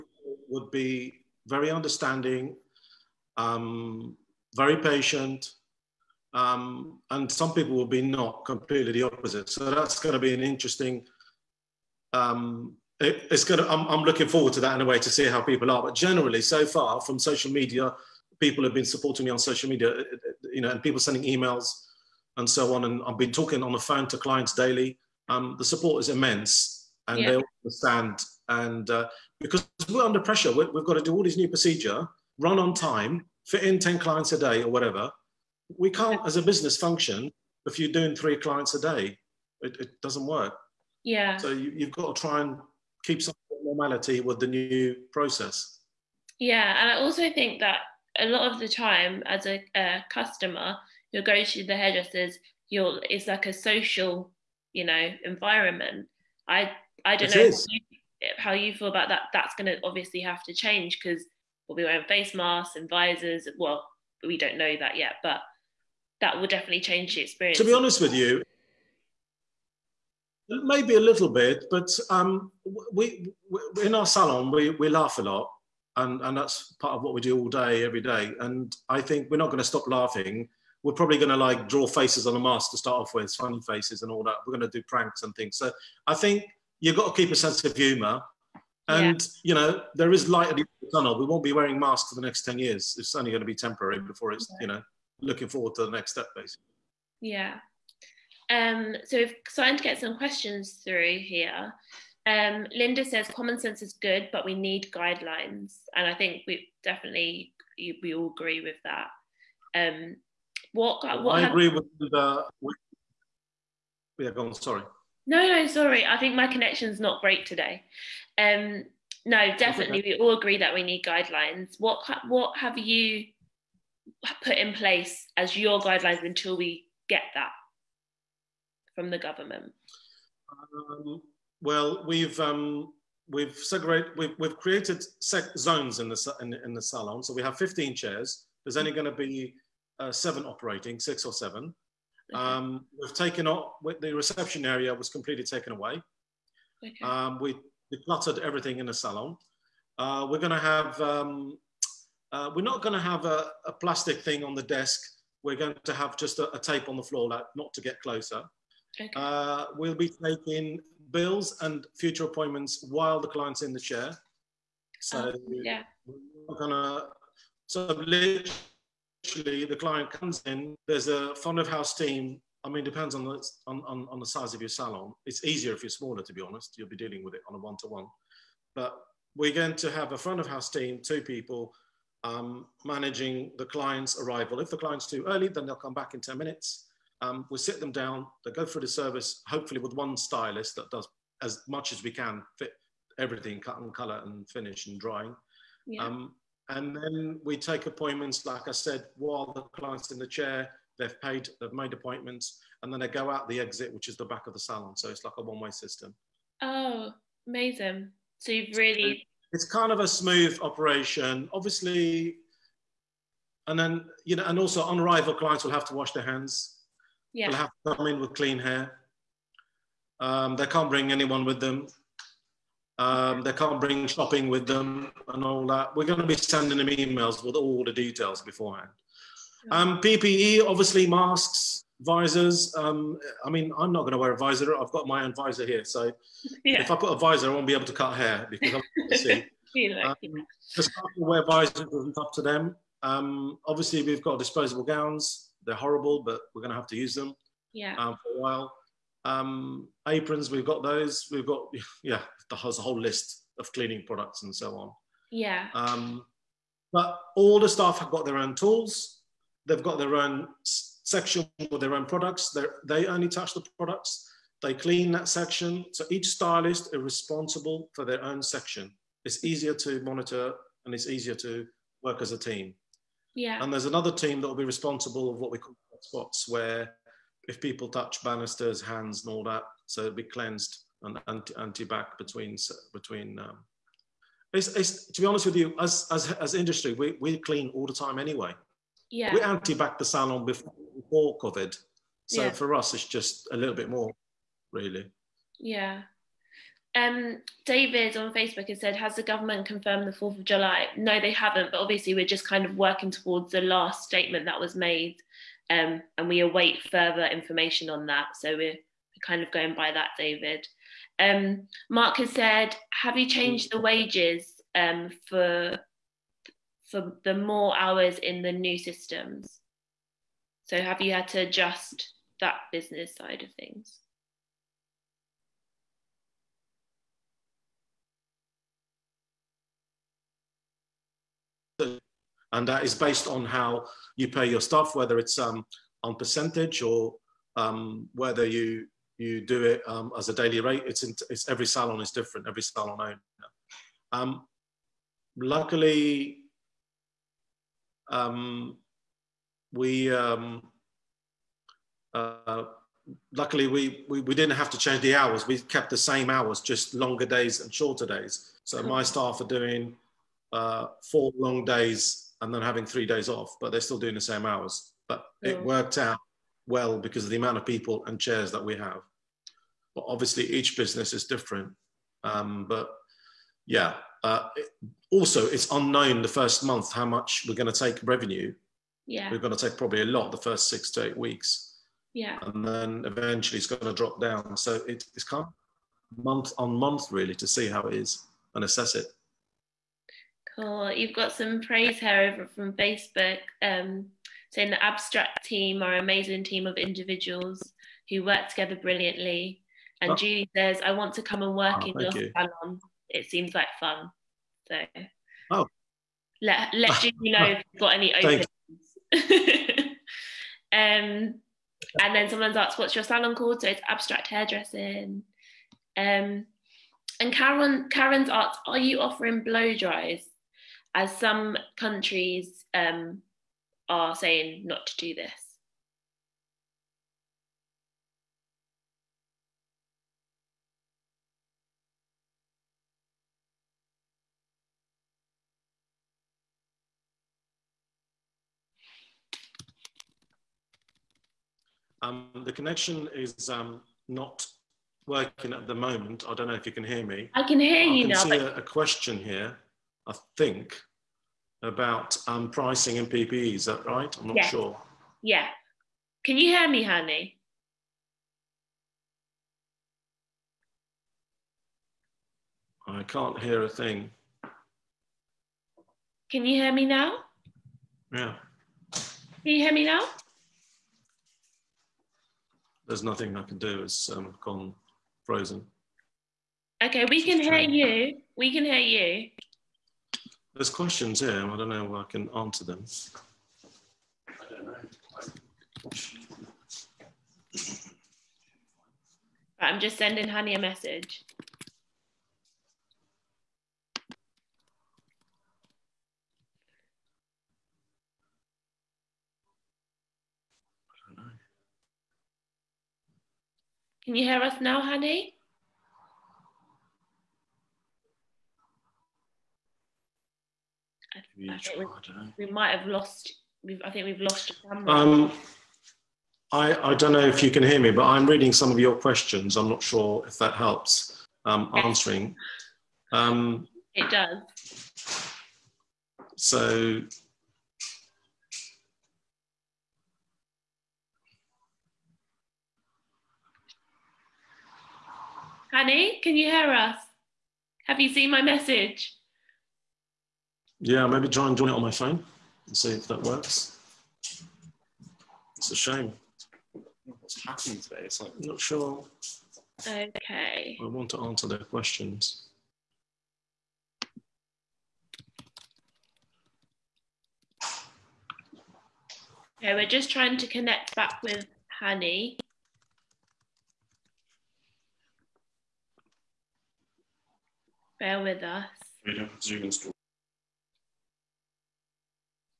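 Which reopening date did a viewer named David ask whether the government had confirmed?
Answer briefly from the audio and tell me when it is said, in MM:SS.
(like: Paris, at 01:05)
4th of July, at 05:00.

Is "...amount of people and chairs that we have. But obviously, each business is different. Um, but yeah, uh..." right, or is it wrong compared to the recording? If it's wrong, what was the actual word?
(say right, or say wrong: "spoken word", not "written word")
right.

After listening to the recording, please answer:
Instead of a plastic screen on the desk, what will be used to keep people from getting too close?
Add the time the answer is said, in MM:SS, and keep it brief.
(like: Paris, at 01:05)
tape on the floor, at 02:36.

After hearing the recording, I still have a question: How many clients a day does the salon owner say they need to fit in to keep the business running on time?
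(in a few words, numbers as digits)
10.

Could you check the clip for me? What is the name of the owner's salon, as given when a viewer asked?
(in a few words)
Abstract Hairdressing.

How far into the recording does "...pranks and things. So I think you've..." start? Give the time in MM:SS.
01:24.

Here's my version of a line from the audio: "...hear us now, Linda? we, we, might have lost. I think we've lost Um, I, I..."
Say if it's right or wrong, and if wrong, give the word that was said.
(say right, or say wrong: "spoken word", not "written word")
wrong: "Hani", not "Linda".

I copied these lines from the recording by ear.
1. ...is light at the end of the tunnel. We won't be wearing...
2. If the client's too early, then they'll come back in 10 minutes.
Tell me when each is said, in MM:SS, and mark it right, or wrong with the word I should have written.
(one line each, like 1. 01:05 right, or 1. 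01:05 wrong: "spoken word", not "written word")
1. 01:30 right
2. 03:04 right.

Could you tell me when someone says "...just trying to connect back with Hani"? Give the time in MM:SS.
09:19.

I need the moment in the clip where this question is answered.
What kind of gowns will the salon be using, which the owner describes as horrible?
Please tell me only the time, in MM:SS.
04:04.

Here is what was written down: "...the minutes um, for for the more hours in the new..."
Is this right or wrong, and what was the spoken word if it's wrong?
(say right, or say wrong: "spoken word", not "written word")
wrong: "wages", not "minutes".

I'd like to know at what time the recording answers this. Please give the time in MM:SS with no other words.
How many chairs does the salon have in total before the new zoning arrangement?
02:17.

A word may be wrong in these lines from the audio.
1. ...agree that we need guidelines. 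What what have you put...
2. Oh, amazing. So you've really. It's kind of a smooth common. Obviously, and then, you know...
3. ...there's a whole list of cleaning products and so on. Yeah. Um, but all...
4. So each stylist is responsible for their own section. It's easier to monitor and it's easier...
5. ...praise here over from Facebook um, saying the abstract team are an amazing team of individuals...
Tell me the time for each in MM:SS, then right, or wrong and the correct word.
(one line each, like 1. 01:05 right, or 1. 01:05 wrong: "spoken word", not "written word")
1. 02:00 right
2. 03:26 wrong: "operation", not "common"
3. 04:12 right
4. 04:25 right
5. 06:31 right.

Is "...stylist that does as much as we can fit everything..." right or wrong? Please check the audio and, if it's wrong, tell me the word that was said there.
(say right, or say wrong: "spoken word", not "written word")
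right.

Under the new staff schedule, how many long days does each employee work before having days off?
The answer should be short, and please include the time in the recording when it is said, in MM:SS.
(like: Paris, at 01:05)
4, at 06:01.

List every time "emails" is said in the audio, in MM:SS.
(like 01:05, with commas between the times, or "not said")
00:21, 03:46.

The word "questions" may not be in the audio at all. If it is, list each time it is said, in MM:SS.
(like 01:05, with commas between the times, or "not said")
01:40, 07:28, 08:00, 08:38, 09:11.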